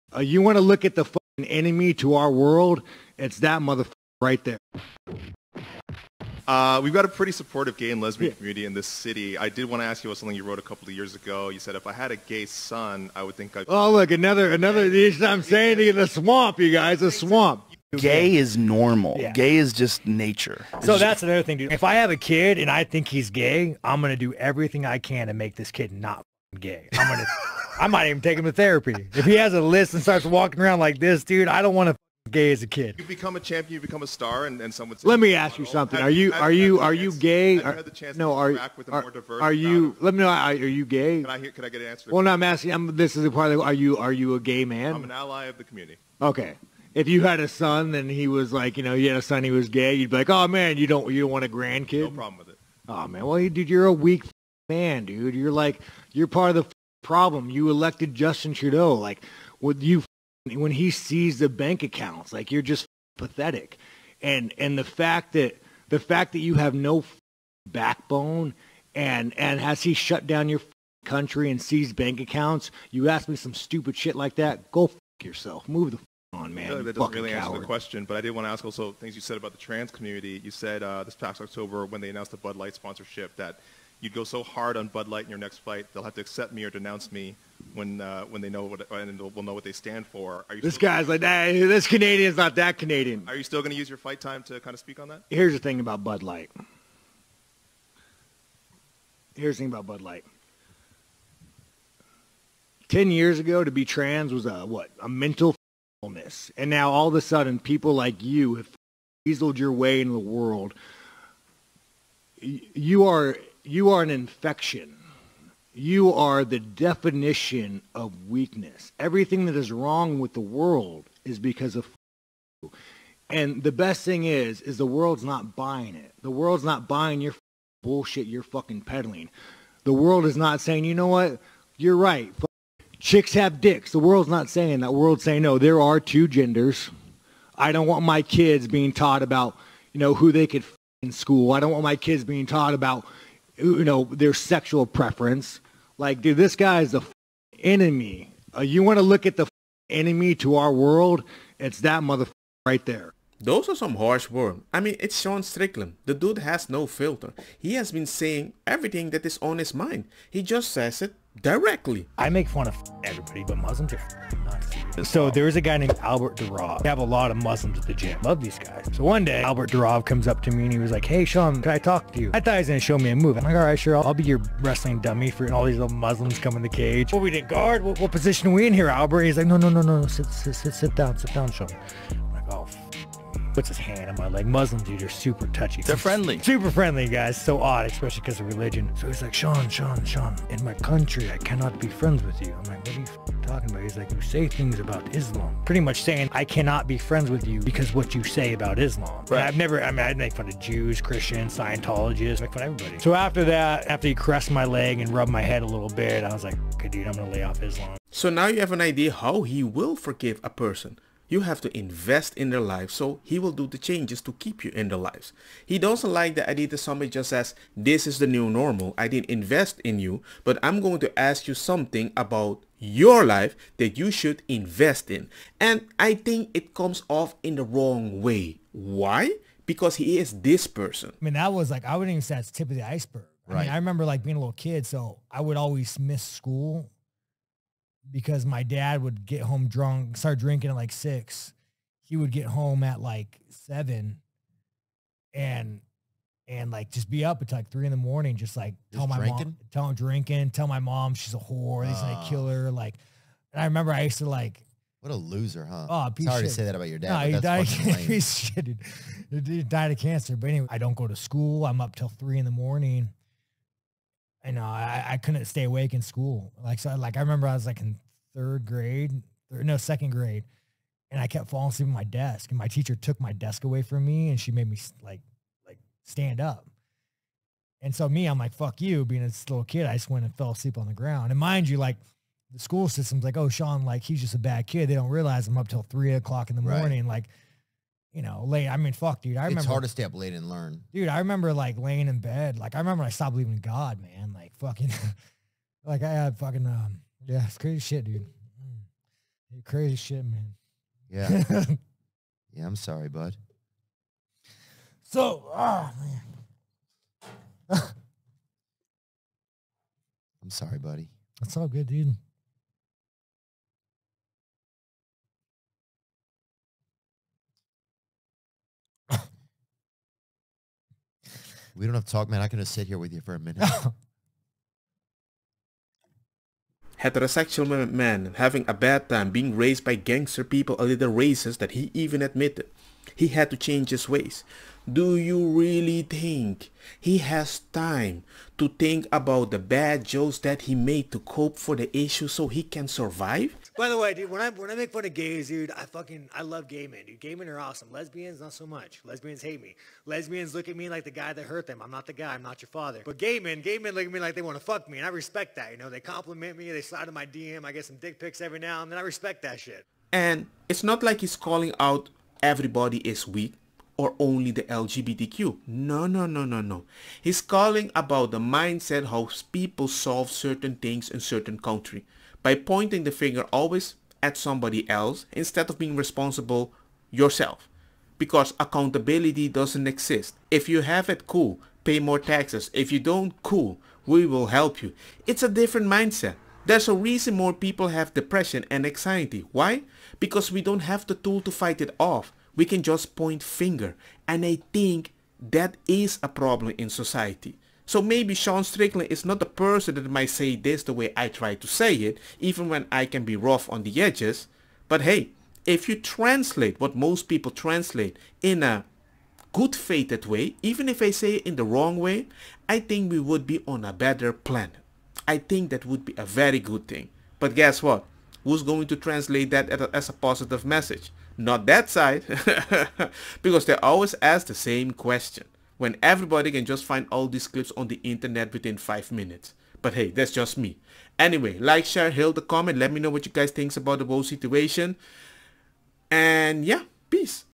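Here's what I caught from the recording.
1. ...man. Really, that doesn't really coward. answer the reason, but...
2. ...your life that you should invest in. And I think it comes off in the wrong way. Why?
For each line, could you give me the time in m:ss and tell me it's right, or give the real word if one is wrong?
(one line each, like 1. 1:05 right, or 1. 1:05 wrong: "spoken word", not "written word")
1. 1:16 wrong: "question", not "reason"
2. 3:42 right.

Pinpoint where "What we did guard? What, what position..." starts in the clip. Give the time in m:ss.
2:57.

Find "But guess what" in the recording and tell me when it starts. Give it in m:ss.
6:57.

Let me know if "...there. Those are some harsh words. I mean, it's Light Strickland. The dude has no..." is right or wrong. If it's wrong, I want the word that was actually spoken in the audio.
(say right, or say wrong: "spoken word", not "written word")
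wrong: "Sean", not "Light".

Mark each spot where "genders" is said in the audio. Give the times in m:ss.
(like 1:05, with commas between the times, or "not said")
2:16.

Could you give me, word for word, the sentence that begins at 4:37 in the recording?
And so me, I'm like, fuck you being this little kid.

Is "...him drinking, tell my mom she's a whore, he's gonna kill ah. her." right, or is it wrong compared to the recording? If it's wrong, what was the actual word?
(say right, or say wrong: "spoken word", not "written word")
right.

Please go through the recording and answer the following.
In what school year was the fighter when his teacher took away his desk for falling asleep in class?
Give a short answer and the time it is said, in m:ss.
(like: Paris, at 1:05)
Second grade, at 4:29.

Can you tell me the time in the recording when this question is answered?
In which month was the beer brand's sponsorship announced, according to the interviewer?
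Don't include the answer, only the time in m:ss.
1:21.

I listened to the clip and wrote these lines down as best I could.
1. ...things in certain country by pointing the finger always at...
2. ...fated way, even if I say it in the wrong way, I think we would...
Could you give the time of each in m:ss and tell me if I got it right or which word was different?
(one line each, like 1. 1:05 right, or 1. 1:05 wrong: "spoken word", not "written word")
1. 6:10 right
2. 6:49 right.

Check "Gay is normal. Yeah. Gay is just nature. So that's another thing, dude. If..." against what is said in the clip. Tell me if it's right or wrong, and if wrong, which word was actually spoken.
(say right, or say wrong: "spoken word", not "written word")
right.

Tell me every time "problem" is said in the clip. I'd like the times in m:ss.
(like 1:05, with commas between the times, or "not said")
0:52, 0:57, 6:36.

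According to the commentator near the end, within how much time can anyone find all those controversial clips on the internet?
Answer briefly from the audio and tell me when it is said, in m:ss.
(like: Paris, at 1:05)
5 minutes, at 7:08.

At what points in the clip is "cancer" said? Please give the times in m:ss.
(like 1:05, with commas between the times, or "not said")
4:19.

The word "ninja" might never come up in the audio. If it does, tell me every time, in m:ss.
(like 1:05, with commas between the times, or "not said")
not said.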